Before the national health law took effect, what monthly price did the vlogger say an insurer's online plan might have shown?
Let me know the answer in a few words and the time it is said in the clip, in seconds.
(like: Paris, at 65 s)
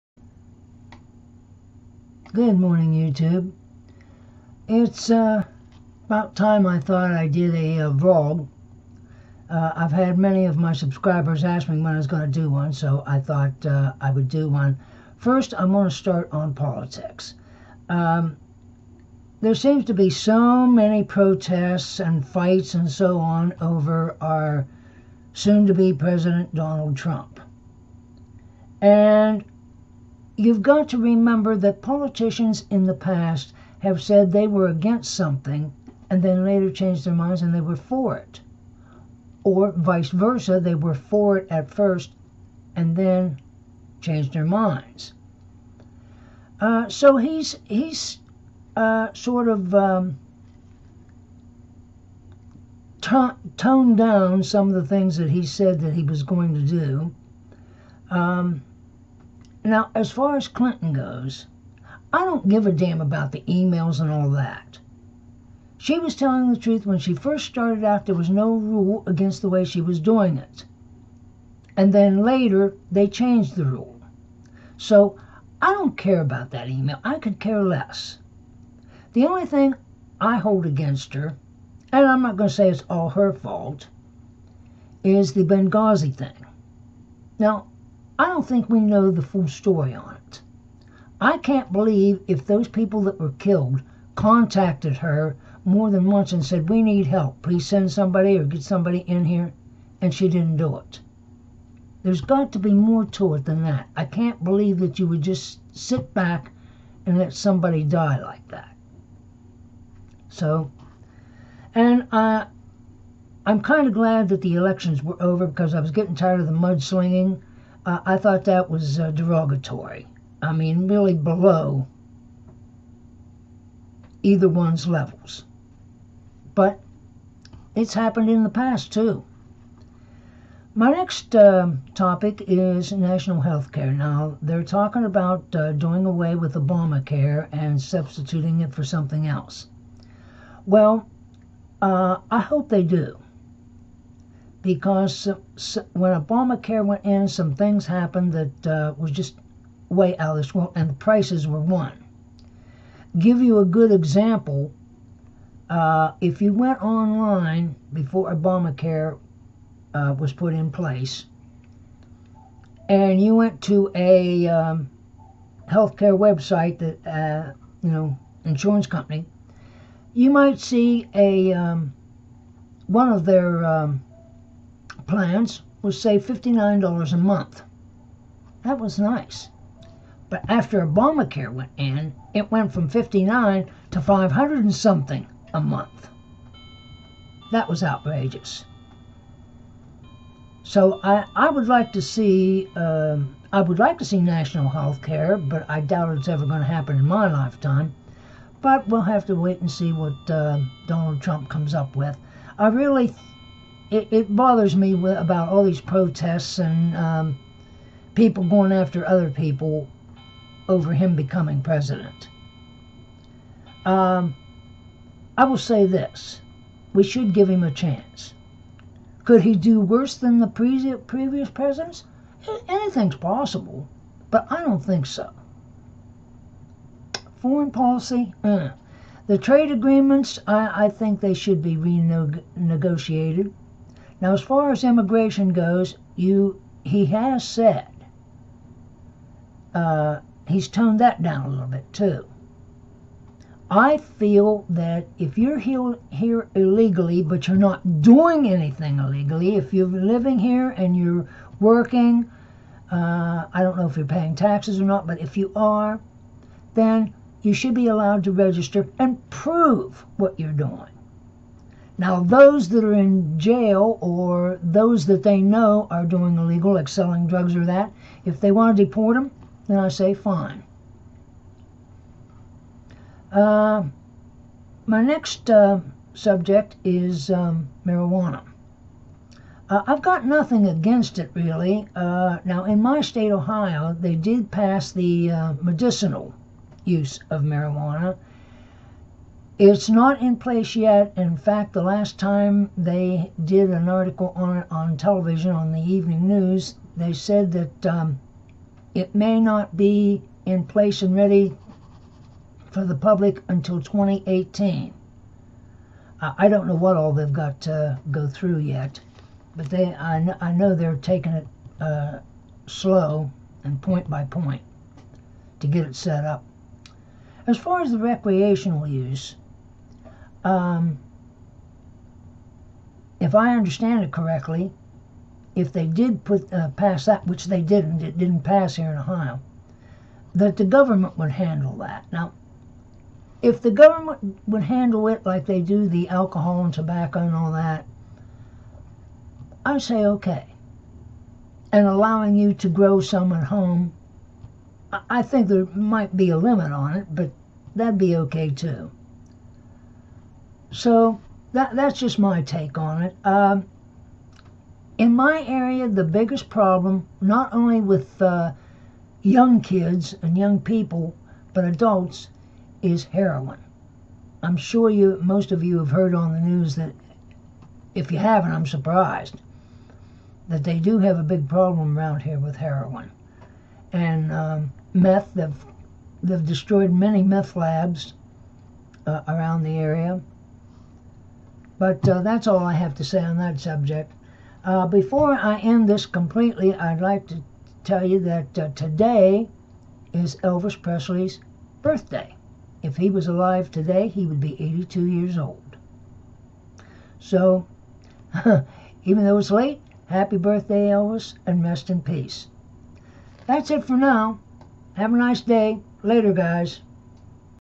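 $59, at 176 s.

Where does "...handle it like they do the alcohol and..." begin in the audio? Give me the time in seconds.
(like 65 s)
334 s.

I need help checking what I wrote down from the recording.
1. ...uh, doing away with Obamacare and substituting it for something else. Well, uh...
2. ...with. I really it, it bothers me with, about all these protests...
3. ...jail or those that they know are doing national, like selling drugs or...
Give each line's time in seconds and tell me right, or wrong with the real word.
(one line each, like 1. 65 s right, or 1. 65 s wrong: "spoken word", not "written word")
1. 135 s right
2. 201 s right
3. 263 s wrong: "illegal", not "national".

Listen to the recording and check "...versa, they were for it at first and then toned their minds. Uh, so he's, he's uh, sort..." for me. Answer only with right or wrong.
wrong.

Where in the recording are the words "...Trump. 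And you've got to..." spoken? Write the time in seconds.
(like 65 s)
26 s.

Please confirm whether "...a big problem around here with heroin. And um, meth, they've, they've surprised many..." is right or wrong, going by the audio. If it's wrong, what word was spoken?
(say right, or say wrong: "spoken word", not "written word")
wrong: "destroyed", not "surprised".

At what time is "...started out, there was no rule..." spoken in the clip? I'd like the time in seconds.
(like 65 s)
67 s.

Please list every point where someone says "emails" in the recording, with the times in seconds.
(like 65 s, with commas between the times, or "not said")
63 s, 76 s.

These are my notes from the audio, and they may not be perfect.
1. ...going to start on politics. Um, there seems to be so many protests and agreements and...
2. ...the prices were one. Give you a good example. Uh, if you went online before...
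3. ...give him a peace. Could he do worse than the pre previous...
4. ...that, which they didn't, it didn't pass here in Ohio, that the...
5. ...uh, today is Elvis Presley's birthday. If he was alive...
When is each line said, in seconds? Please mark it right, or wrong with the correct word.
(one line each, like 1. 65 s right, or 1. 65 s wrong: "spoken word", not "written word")
1. 15 s wrong: "fights", not "agreements"
2. 150 s right
3. 217 s wrong: "chance", not "peace"
4. 327 s right
5. 388 s right.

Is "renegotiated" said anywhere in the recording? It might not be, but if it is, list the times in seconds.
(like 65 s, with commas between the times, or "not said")
231 s.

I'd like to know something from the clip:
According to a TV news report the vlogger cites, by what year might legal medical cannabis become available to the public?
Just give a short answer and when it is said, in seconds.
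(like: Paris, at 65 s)
2018, at 303 s.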